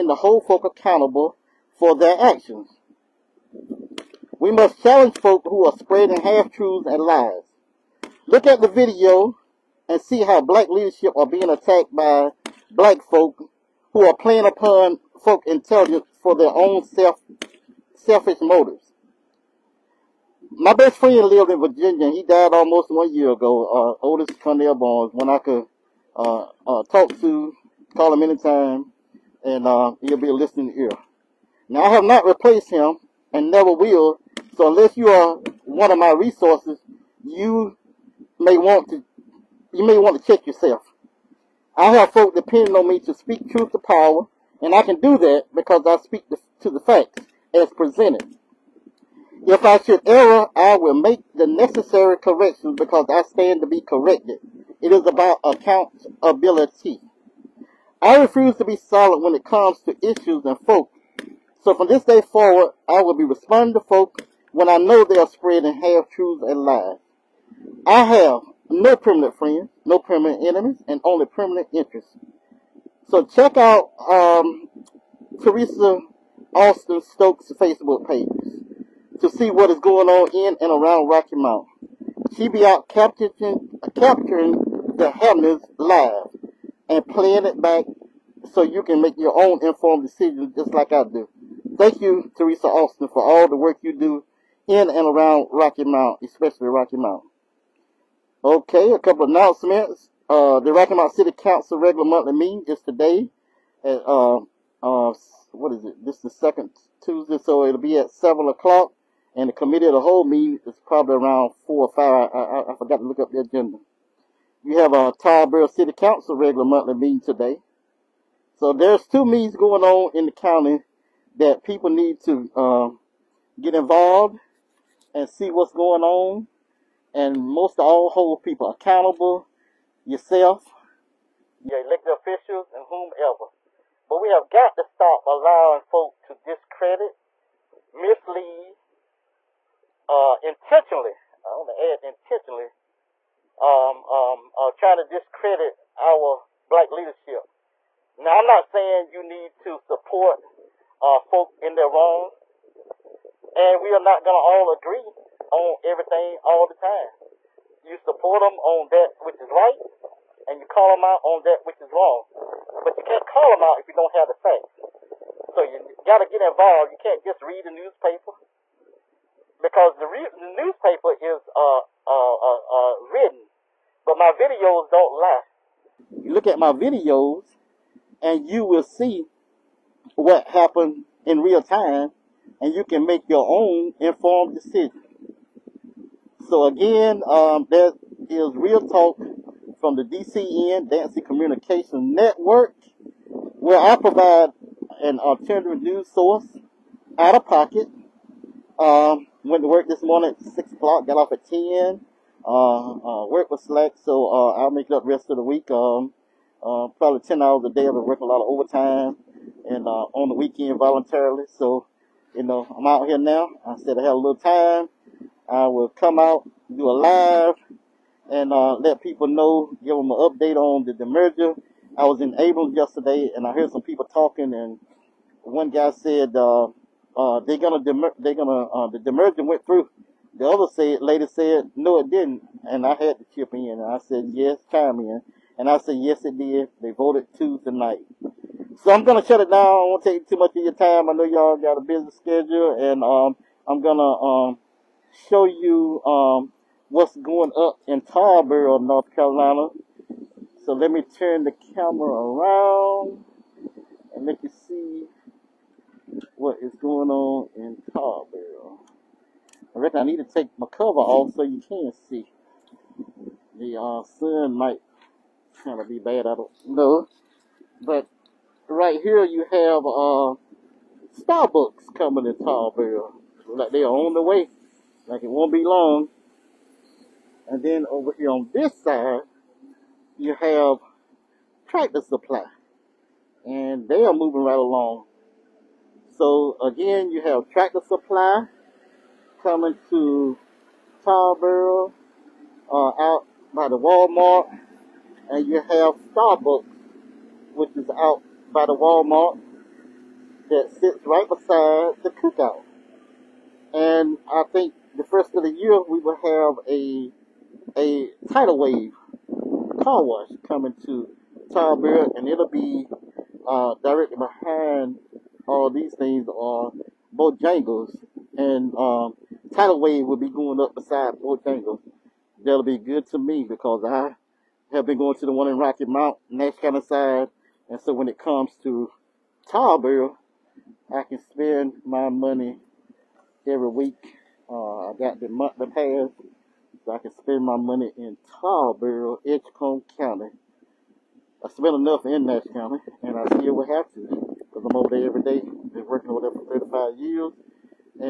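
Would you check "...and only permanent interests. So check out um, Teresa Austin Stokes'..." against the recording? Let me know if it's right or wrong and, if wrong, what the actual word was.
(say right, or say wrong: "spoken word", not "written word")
right.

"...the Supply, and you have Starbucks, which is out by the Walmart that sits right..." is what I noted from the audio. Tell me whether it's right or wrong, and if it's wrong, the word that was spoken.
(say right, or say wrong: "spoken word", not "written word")
wrong: "Walmart", not "Supply".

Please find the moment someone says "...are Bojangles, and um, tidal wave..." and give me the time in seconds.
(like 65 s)
316 s.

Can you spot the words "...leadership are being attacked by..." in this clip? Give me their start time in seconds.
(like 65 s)
10 s.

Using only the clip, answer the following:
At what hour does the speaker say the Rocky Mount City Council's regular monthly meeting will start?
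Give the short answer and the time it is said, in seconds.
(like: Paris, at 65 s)
7 o'clock, at 108 s.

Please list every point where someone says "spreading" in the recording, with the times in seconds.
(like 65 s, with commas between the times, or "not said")
5 s, 65 s.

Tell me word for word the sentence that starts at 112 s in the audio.
I, I, I forgot to look up the agenda.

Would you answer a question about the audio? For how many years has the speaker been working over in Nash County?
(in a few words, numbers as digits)
35 years.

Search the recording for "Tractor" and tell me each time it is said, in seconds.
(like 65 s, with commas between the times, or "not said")
281 s, 287 s.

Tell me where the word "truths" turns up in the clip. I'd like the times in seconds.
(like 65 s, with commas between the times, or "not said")
6 s, 43 s, 66 s.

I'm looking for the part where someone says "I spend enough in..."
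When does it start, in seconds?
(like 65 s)
341 s.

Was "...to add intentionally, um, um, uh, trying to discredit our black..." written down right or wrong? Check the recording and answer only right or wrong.
right.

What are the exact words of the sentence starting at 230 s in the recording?
The other said lady said no, it didn't, and I had to chip in.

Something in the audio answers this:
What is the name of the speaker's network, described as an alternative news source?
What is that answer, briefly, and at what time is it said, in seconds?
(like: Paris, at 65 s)
Dancy Communication Network, at 190 s.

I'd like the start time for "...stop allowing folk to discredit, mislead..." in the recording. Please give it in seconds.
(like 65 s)
134 s.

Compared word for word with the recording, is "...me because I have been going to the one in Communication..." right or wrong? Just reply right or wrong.
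wrong.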